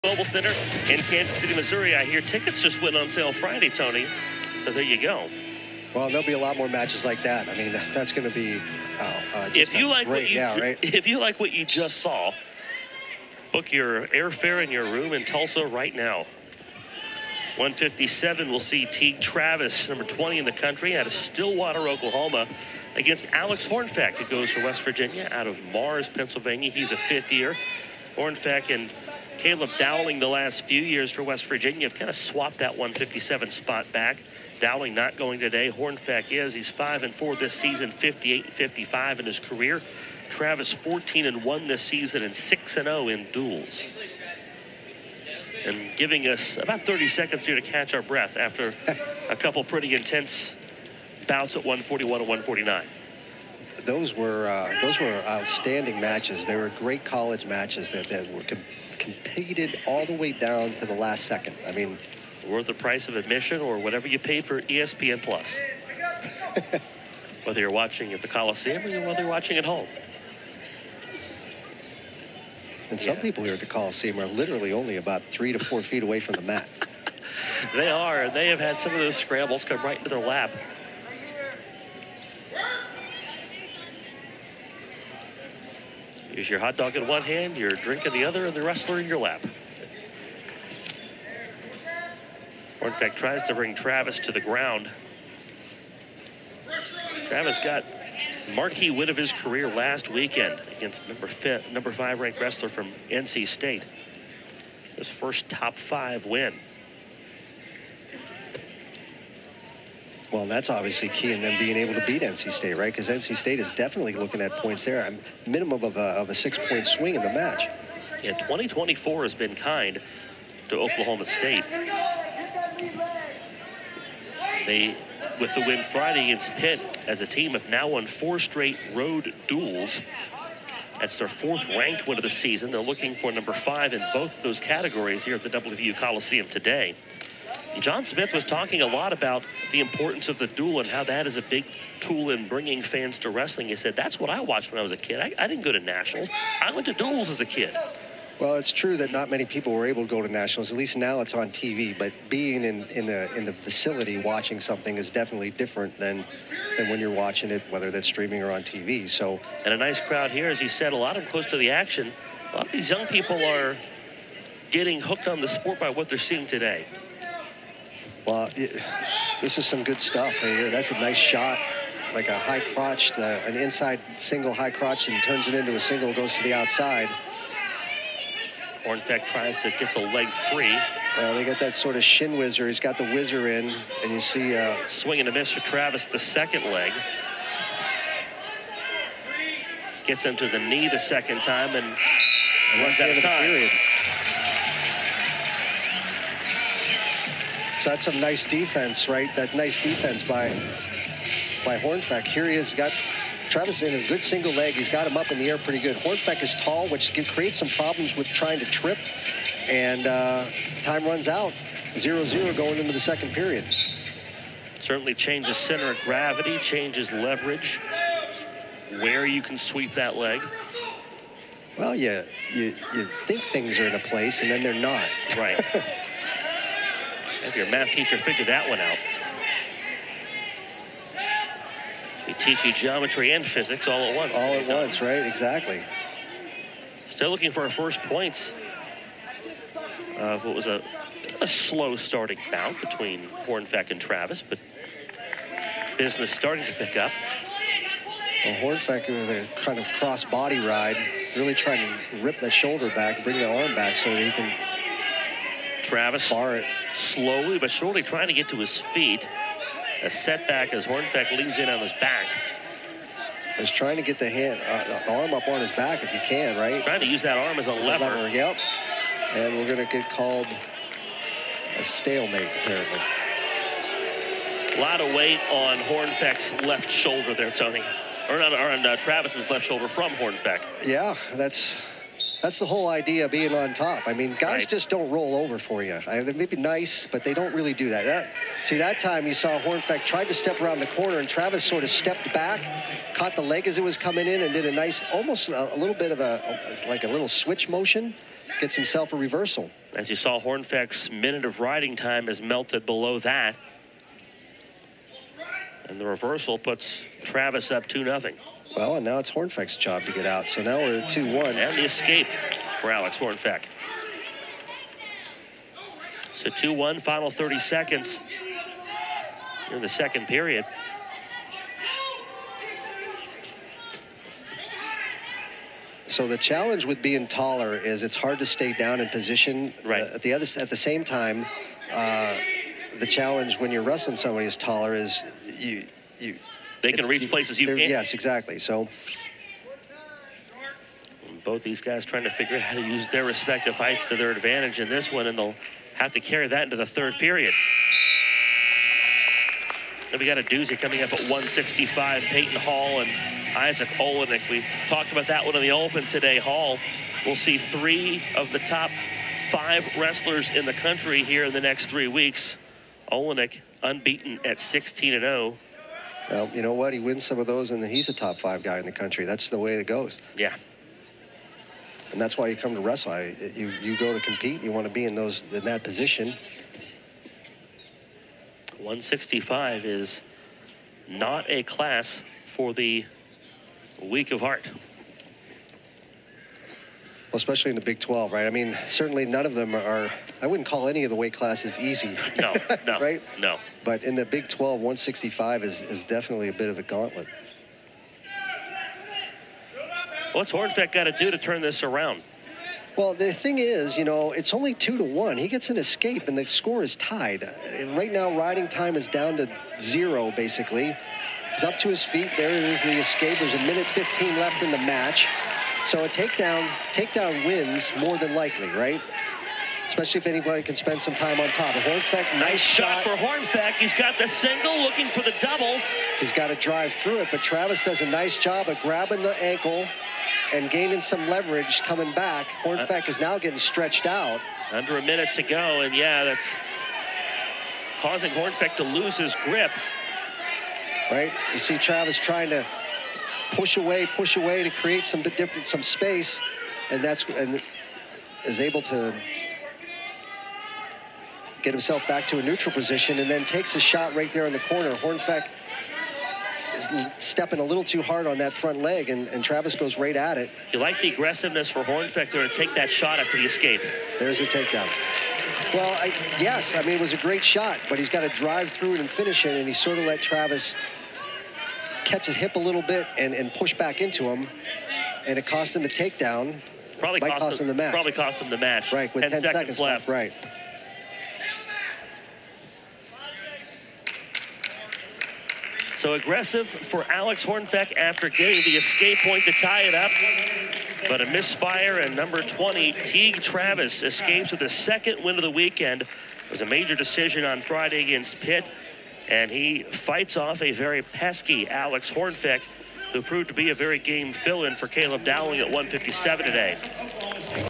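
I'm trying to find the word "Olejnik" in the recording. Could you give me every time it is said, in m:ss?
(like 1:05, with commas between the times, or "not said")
5:53, 6:03.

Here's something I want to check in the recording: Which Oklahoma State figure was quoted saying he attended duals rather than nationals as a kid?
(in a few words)
John Smith.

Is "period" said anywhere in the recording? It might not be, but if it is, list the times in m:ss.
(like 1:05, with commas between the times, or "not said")
3:13, 3:33, 5:20, 5:47.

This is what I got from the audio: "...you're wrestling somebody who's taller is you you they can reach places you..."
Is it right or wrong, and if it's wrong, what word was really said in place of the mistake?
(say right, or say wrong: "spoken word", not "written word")
right.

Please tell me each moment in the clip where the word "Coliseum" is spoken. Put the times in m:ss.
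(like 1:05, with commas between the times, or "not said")
1:08, 1:13, 2:15.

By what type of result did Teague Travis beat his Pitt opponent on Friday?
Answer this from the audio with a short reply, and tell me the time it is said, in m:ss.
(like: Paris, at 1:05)
Major decision, at 8:16.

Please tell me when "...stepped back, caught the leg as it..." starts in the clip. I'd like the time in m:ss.
4:51.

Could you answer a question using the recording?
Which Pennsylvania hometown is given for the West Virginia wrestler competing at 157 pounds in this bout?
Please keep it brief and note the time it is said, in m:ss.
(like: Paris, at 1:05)
Mars, Pennsylvania, at 0:25.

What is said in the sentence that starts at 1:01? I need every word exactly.
I mean, worth the price of admission or whatever you paid for ESPN Plus.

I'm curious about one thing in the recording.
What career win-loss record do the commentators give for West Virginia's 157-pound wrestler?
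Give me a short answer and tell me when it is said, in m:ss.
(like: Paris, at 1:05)
58 and 55, at 0:37.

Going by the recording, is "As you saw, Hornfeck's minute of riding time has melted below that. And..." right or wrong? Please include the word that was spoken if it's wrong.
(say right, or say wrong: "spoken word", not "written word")
right.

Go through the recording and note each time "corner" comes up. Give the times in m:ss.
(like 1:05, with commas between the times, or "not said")
4:50, 7:34.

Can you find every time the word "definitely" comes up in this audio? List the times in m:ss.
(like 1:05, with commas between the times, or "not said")
1:53, 2:35, 6:36.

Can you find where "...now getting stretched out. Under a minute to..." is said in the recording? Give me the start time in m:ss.
7:13.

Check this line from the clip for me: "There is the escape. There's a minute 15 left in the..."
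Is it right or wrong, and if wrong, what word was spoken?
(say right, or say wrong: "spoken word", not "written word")
right.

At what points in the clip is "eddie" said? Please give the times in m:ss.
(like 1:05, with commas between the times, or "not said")
not said.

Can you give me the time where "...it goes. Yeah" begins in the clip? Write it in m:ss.
6:09.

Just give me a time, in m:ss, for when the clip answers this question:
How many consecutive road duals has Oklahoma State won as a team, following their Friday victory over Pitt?
2:08.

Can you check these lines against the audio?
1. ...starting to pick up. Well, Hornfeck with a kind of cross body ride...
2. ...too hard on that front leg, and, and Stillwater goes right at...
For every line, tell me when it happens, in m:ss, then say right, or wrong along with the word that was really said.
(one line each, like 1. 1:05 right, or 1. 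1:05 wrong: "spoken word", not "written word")
1. 4:06 right
2. 7:37 wrong: "Travis", not "Stillwater".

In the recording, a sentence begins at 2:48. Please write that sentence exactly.
Well, it, this is some good stuff right here.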